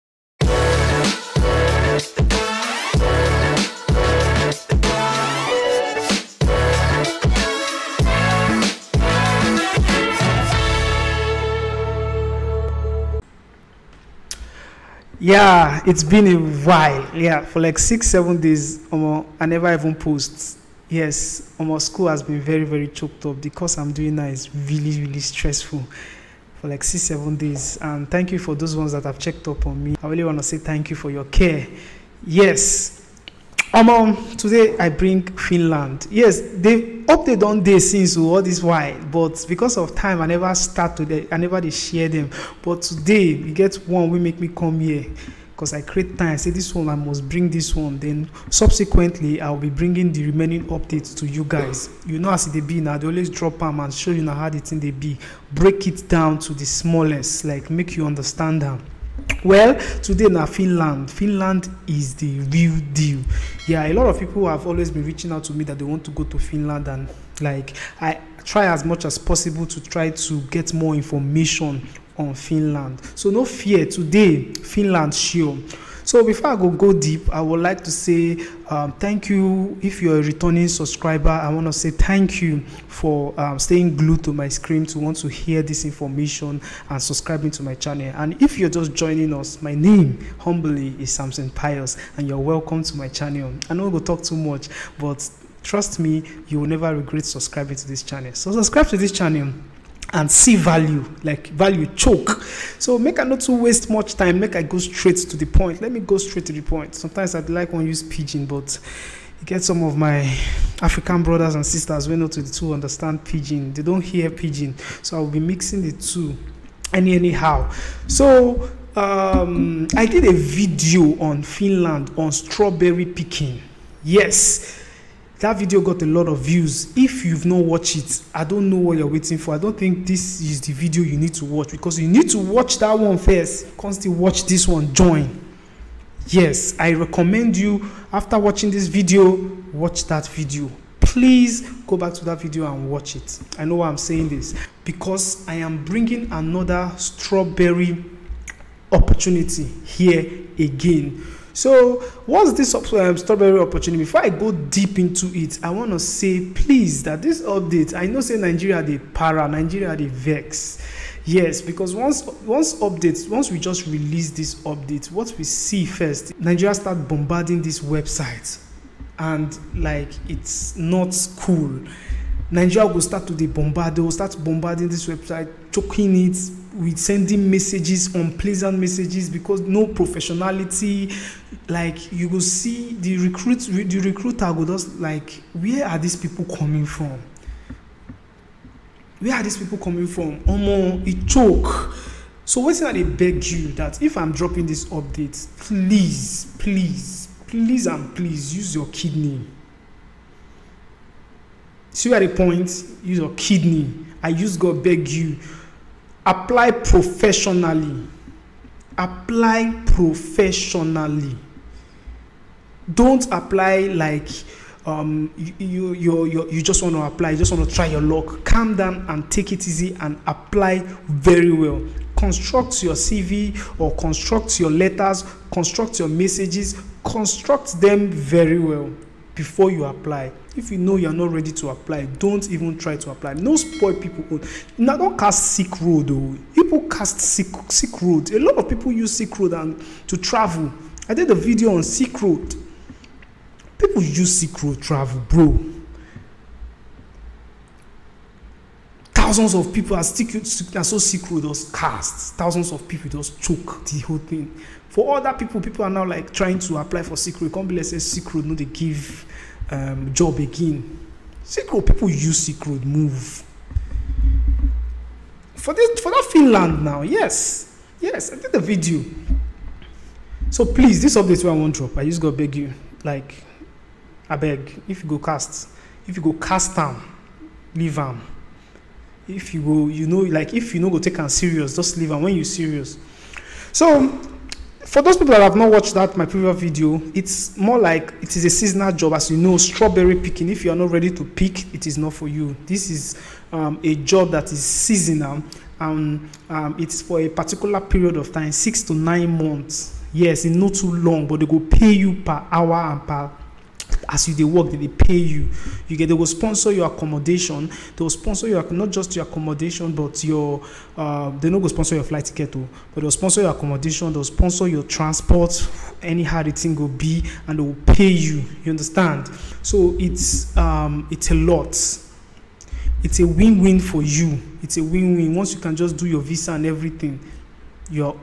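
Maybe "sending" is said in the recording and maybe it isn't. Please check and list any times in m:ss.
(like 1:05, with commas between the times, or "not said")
2:56.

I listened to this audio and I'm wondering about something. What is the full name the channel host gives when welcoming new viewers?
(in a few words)
Samson Pius.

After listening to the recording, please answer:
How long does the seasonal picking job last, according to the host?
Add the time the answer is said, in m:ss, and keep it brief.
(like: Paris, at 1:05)
6 to 9 months, at 4:58.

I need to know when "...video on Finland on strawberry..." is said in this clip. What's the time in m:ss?
2:00.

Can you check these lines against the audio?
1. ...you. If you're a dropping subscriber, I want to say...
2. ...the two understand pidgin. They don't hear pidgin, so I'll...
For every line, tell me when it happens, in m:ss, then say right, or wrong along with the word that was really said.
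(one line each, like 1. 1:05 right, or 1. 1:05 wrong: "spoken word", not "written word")
1. 1:19 wrong: "returning", not "dropping"
2. 1:52 right.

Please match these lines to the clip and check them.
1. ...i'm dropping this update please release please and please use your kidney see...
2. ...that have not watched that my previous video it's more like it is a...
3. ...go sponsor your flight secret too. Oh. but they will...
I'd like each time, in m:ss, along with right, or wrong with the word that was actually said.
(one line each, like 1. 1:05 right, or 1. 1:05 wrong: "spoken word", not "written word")
1. 3:14 wrong: "please", not "release"
2. 4:45 right
3. 5:11 wrong: "ticket", not "secret".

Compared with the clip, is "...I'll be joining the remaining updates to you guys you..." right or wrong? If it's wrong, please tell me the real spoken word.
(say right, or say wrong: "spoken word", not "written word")
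wrong: "bringing", not "joining".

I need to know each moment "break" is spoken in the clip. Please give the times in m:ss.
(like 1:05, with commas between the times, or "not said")
0:55.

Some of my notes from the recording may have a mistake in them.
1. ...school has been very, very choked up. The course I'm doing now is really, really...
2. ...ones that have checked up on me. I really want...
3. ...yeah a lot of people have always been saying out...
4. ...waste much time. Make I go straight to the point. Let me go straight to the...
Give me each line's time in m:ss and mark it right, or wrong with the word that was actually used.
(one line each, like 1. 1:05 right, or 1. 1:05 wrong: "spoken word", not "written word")
1. 0:21 right
2. 0:28 right
3. 1:03 wrong: "reaching", not "saying"
4. 1:43 right.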